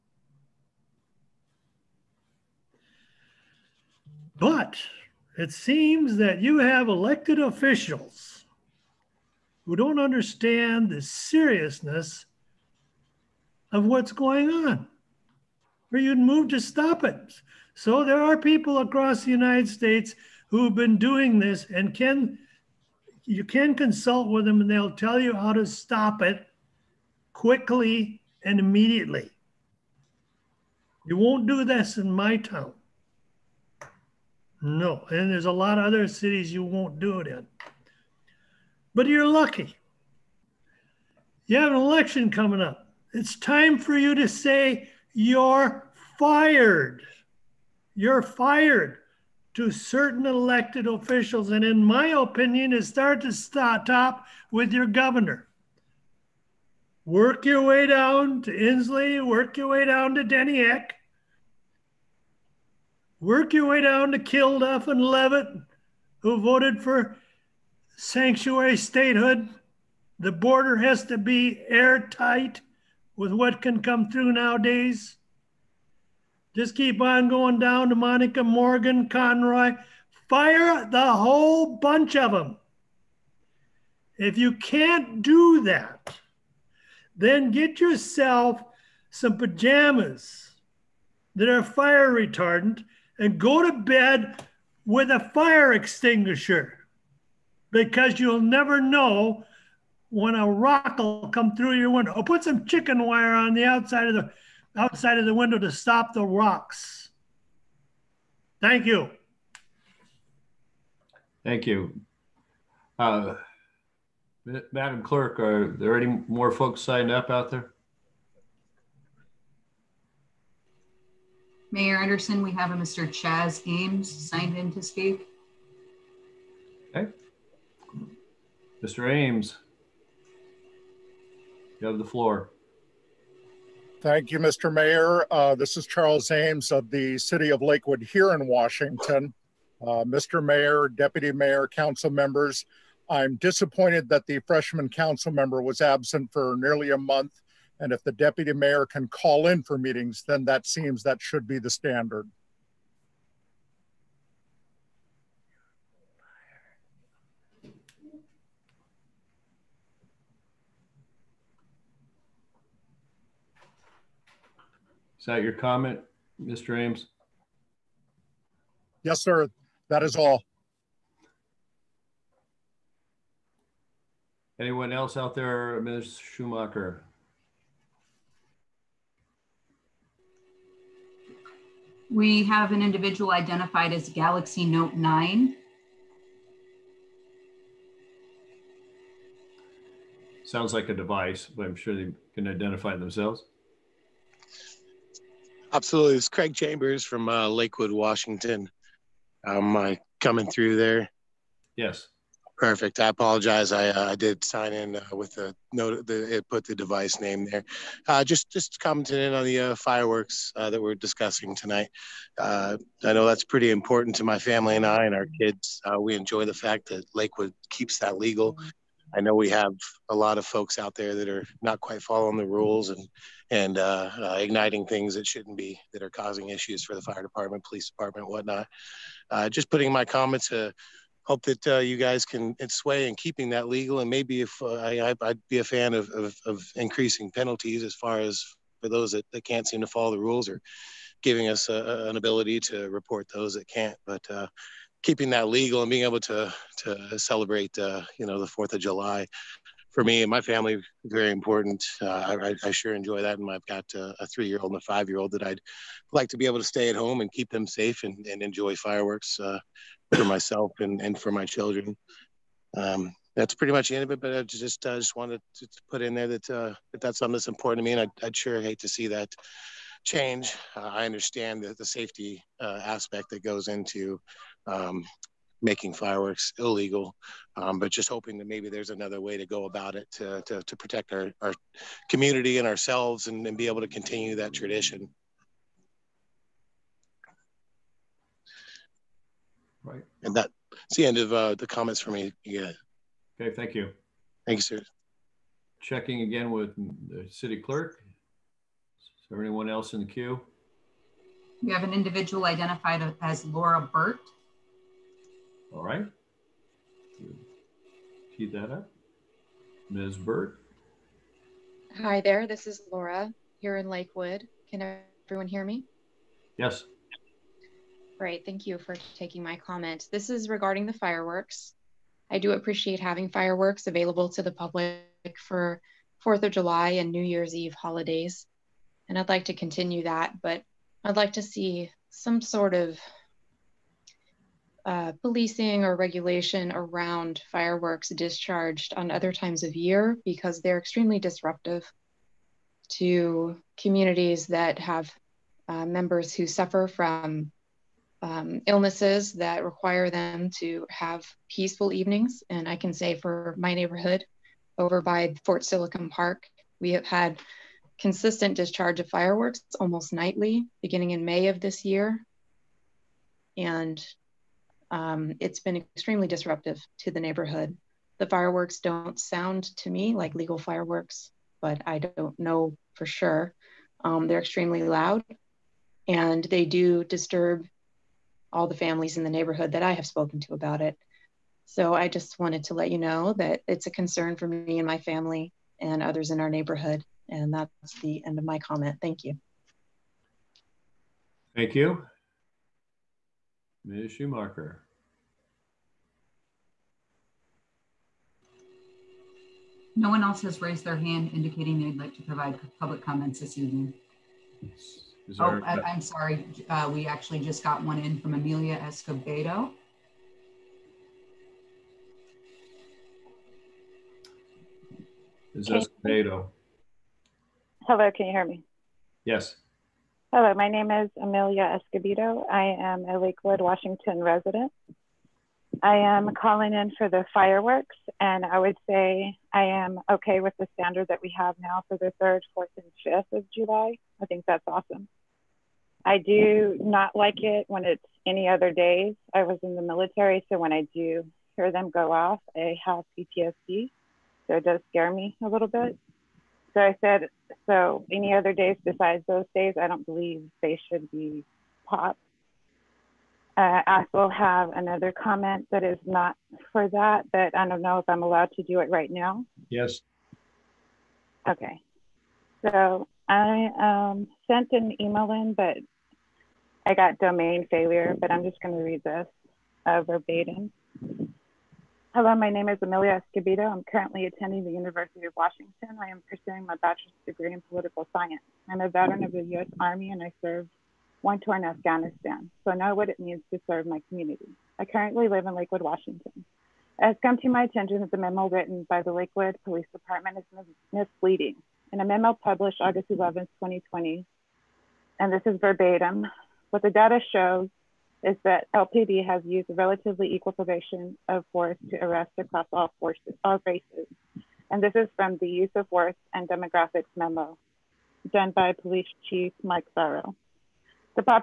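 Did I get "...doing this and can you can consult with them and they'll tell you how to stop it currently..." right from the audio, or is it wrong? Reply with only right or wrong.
wrong.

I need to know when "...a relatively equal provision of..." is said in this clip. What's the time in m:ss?
8:19.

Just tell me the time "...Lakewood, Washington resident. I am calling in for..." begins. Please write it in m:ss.
7:03.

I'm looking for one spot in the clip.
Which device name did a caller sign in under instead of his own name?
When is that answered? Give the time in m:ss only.
3:04.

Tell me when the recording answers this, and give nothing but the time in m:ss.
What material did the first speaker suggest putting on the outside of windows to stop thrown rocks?
1:42.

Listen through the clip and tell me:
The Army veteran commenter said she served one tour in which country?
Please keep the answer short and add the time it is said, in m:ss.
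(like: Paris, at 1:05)
Afghanistan, at 8:01.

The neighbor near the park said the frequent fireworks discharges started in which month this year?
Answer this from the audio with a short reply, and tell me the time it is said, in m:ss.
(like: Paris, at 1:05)
May, at 6:01.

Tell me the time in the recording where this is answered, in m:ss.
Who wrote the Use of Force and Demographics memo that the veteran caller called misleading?
8:29.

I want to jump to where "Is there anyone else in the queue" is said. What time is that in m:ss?
4:58.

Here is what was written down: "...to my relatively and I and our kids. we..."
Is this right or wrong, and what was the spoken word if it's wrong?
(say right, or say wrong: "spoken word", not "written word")
wrong: "family", not "relatively".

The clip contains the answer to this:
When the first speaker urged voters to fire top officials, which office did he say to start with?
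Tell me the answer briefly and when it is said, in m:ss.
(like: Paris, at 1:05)
Governor, at 0:54.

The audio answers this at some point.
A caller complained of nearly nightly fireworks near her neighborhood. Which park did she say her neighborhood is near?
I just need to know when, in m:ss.
5:55.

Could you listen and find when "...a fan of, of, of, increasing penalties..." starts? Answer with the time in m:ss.
3:55.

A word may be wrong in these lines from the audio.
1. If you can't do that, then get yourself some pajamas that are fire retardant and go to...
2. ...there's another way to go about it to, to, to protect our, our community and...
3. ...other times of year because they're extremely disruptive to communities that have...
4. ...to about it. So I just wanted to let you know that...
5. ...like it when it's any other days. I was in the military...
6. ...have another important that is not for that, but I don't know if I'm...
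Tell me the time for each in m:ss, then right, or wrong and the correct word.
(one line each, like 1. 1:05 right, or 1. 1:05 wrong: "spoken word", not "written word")
1. 1:24 right
2. 4:38 right
3. 5:39 right
4. 6:20 right
5. 7:17 right
6. 7:34 wrong: "comment", not "important".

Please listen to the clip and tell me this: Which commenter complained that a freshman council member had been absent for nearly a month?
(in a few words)
Charles Ames.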